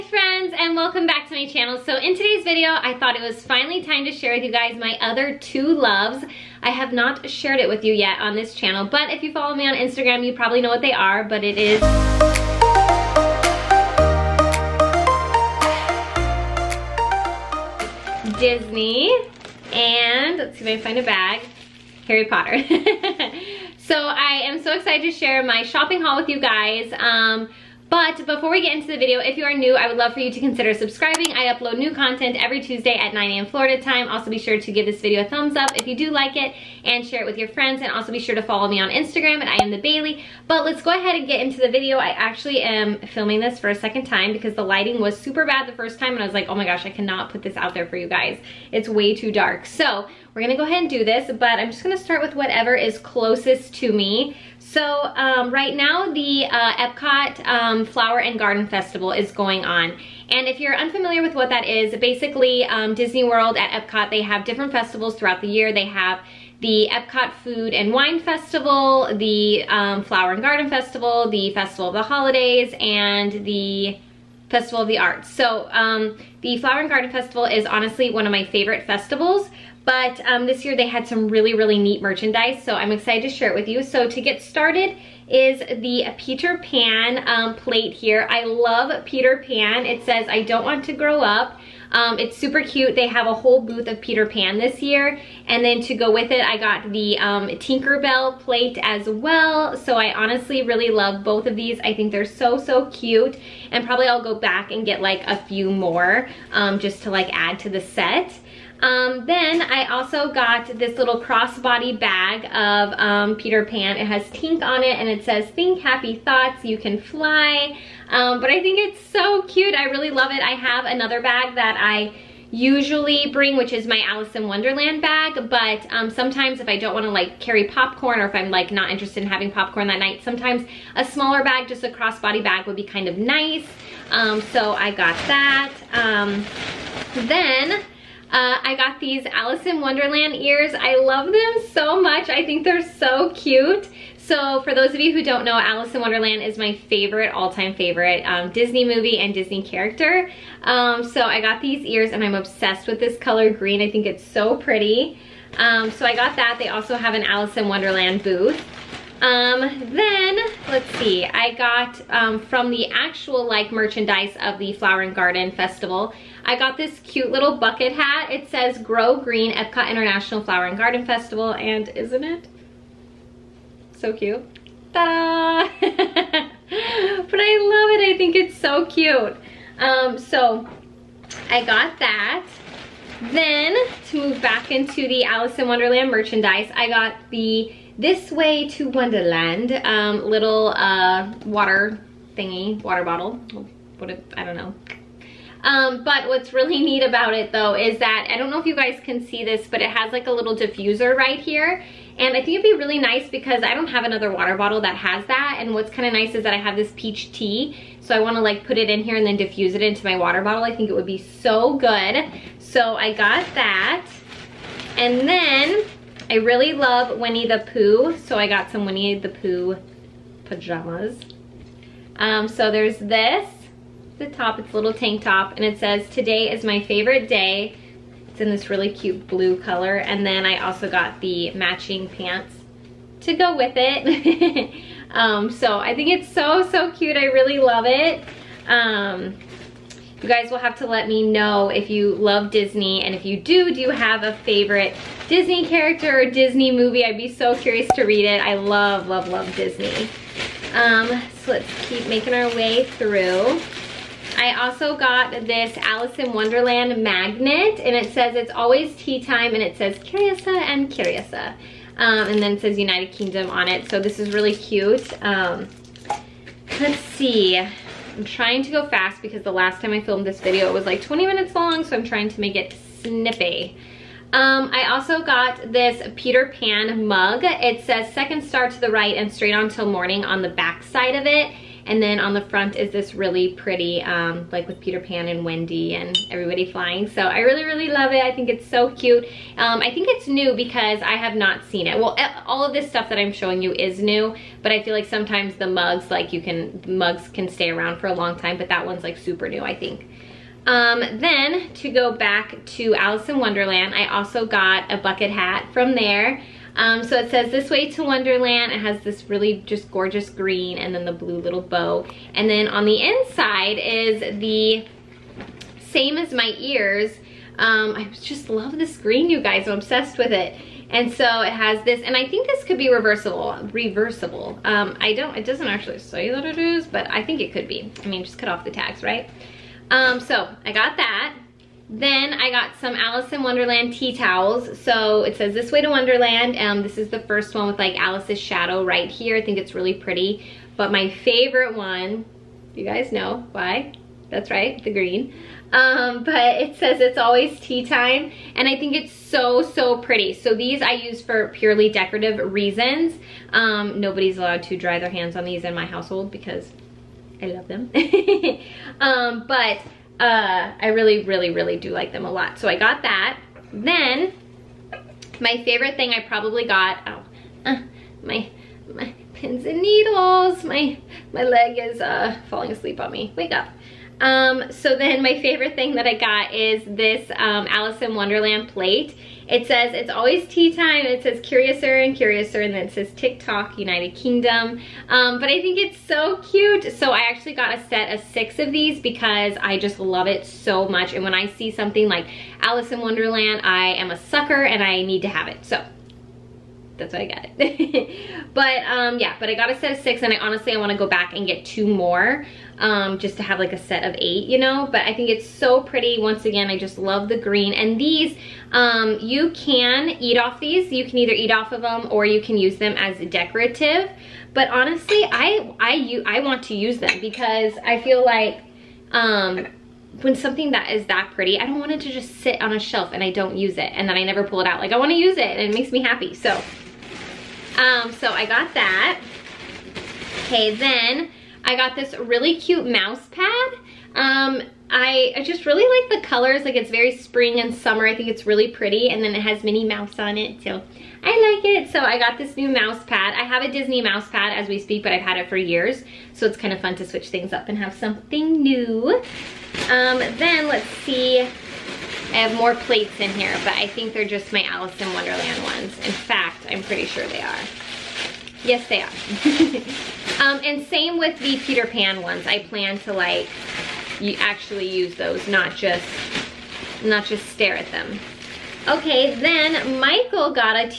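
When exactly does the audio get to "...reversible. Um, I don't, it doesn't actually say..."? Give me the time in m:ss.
5:23.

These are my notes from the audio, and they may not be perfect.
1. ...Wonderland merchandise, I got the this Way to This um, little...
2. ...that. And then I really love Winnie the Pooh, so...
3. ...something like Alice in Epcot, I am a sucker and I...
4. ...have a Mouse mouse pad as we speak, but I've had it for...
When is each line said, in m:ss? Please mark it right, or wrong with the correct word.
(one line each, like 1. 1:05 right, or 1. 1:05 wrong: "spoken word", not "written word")
1. 3:05 wrong: "Wonderland", not "This"
2. 3:33 right
3. 6:31 wrong: "Wonderland", not "Epcot"
4. 7:23 wrong: "Disney", not "Mouse".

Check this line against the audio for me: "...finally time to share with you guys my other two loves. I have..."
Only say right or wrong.
right.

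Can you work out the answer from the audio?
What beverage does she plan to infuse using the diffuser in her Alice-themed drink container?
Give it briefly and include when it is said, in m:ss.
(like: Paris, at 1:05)
peach tea, at 3:26.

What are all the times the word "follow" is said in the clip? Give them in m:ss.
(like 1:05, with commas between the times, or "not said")
0:09, 0:38.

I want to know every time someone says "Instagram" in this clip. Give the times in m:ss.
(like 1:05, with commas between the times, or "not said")
0:09, 0:38.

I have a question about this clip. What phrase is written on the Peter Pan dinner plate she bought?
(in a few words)
I don't want to grow up.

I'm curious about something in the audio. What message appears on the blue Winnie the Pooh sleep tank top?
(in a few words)
today is my favorite day.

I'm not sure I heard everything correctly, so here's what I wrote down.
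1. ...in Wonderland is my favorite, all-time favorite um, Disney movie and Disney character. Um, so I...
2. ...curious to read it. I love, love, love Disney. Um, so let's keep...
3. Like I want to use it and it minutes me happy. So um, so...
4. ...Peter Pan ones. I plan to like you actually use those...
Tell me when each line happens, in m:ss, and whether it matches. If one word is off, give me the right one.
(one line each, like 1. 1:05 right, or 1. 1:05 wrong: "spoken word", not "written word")
1. 2:25 right
2. 4:07 right
3. 7:04 wrong: "makes", not "minutes"
4. 7:41 right.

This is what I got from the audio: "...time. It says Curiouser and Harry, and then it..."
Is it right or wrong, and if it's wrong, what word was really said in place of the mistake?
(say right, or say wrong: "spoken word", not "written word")
wrong: "Curiouser", not "Harry".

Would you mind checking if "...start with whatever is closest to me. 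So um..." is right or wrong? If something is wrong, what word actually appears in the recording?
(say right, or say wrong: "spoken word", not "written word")
right.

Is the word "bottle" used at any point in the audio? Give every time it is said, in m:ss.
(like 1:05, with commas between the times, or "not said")
3:13, 3:24, 3:30.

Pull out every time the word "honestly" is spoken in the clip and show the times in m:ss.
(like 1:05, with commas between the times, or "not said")
1:17, 1:40, 6:40, 6:54.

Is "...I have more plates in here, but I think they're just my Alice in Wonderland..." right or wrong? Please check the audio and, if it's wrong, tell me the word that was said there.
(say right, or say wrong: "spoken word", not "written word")
right.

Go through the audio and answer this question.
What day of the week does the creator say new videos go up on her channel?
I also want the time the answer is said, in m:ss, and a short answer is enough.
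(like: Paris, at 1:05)
Tuesday, at 0:32.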